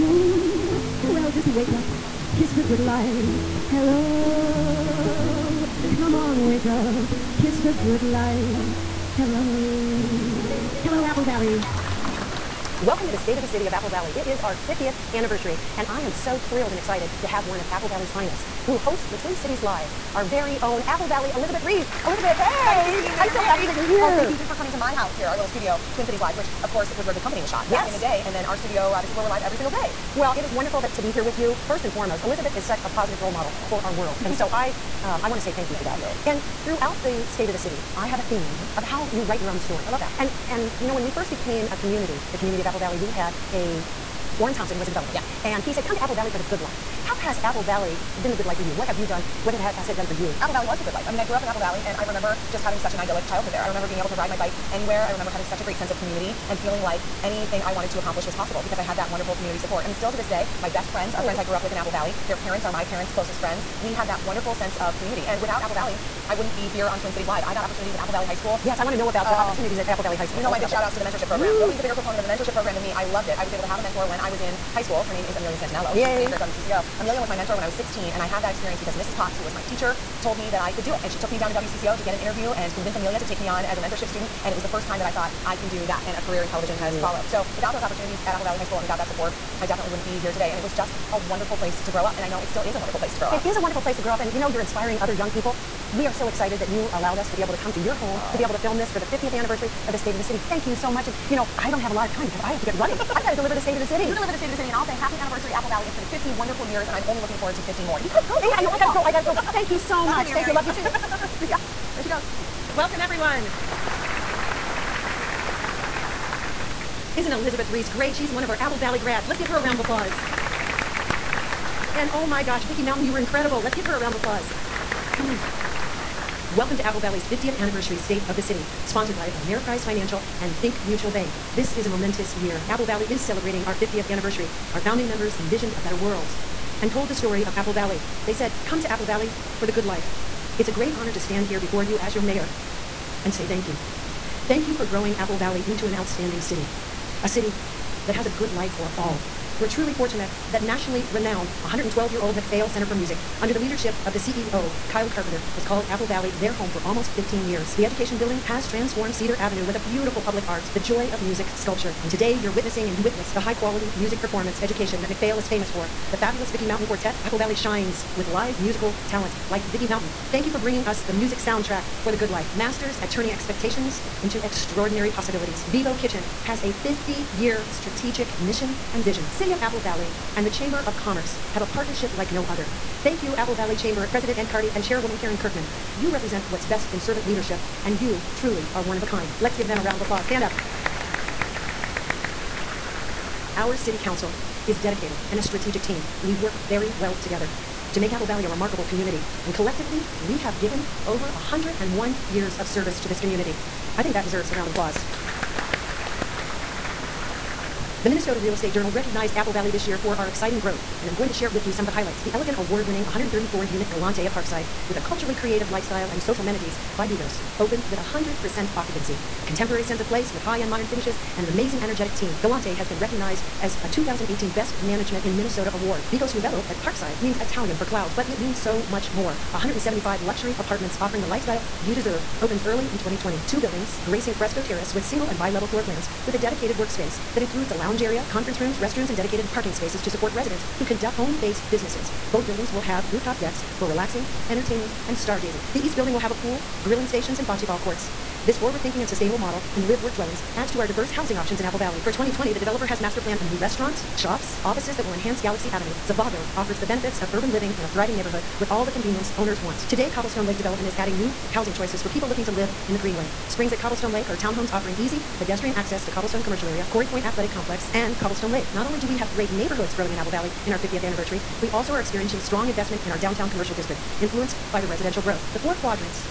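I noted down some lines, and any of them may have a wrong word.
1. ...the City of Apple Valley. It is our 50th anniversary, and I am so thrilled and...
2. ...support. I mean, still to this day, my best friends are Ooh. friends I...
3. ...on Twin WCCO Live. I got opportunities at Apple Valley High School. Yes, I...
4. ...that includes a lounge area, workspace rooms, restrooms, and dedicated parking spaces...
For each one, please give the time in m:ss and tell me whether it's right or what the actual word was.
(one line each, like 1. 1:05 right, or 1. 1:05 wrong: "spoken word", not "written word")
1. 0:13 right
2. 0:59 right
3. 1:06 wrong: "Cities", not "WCCO"
4. 3:57 wrong: "conference", not "workspace".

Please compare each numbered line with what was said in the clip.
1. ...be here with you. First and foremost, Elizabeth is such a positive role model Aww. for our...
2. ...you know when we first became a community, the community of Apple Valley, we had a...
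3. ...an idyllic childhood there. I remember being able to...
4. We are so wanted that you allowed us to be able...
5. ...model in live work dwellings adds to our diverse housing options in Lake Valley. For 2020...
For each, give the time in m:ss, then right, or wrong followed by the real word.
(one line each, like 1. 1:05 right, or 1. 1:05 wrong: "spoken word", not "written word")
1. 0:31 right
2. 0:40 right
3. 0:52 right
4. 1:35 wrong: "excited", not "wanted"
5. 4:09 wrong: "Apple", not "Lake".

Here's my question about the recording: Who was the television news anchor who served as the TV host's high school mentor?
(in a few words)
Amelia Santaniello.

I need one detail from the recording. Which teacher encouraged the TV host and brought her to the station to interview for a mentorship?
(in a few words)
Mrs. Potts.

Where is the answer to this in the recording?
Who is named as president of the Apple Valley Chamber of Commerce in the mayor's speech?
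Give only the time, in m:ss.
3:04.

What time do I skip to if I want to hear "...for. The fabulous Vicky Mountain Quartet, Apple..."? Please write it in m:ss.
2:45.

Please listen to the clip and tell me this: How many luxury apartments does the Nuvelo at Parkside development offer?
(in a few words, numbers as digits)
175.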